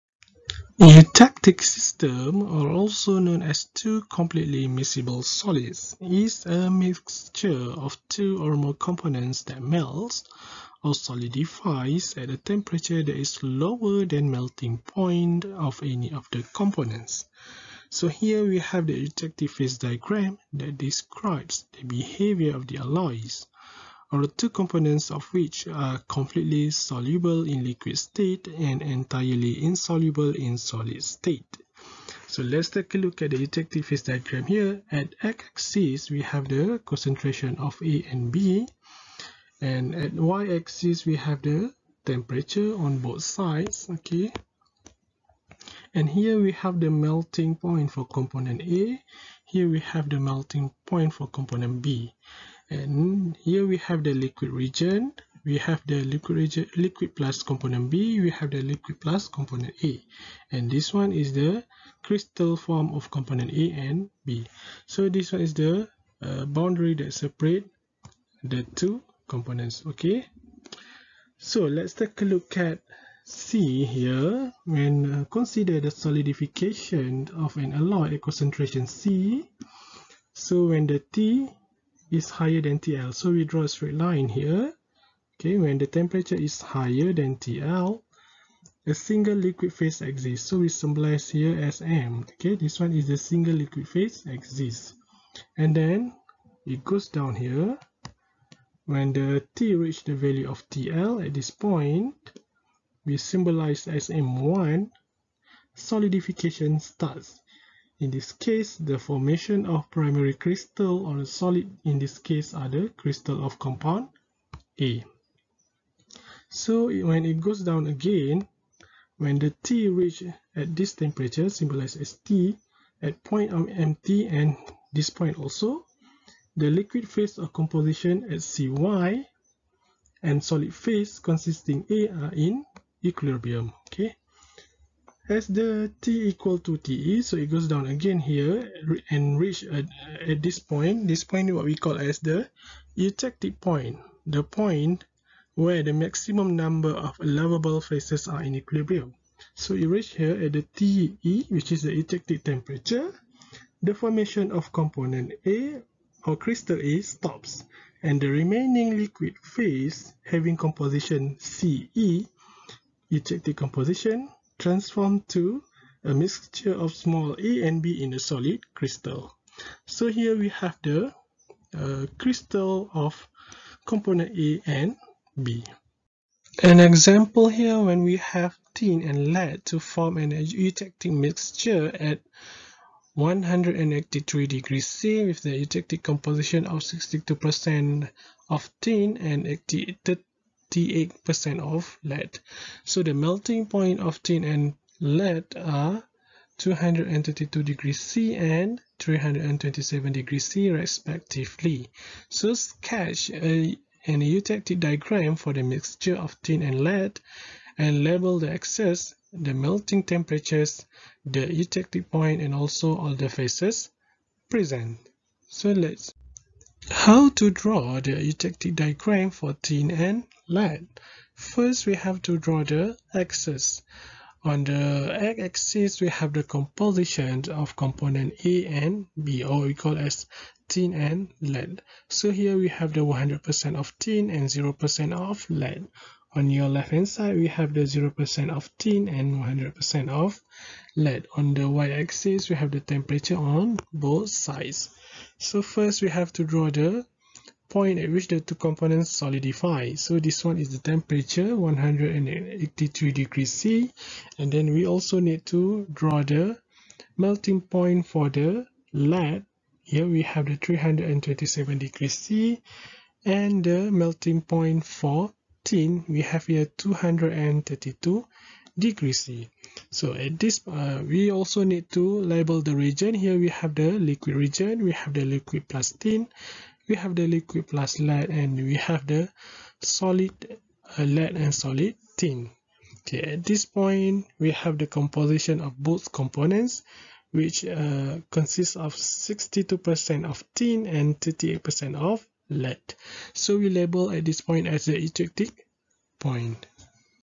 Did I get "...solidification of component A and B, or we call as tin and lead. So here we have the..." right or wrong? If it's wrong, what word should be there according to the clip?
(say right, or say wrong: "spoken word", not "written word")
wrong: "composition", not "solidification".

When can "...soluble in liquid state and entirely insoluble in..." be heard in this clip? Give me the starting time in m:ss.
0:26.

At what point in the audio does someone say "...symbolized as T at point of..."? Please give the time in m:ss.
2:01.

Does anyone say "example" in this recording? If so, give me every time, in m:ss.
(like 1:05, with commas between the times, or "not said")
2:56.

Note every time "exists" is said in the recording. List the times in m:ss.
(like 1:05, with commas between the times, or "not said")
1:30, 1:34.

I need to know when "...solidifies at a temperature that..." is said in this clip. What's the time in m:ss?
0:10.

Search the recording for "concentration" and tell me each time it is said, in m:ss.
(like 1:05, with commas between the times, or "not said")
0:36, 1:18.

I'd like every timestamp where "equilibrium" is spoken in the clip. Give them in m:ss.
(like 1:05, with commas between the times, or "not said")
2:13, 2:28.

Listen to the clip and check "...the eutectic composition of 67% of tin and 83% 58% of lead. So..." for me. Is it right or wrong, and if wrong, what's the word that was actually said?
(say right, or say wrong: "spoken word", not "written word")
wrong: "62", not "67".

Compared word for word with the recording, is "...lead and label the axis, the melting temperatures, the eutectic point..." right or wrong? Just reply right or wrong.
right.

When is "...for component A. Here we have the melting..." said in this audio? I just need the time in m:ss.
0:47.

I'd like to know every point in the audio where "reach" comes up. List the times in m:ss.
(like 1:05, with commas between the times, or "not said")
1:39, 1:59, 2:19, 2:29.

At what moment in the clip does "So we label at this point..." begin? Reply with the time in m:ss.
4:53.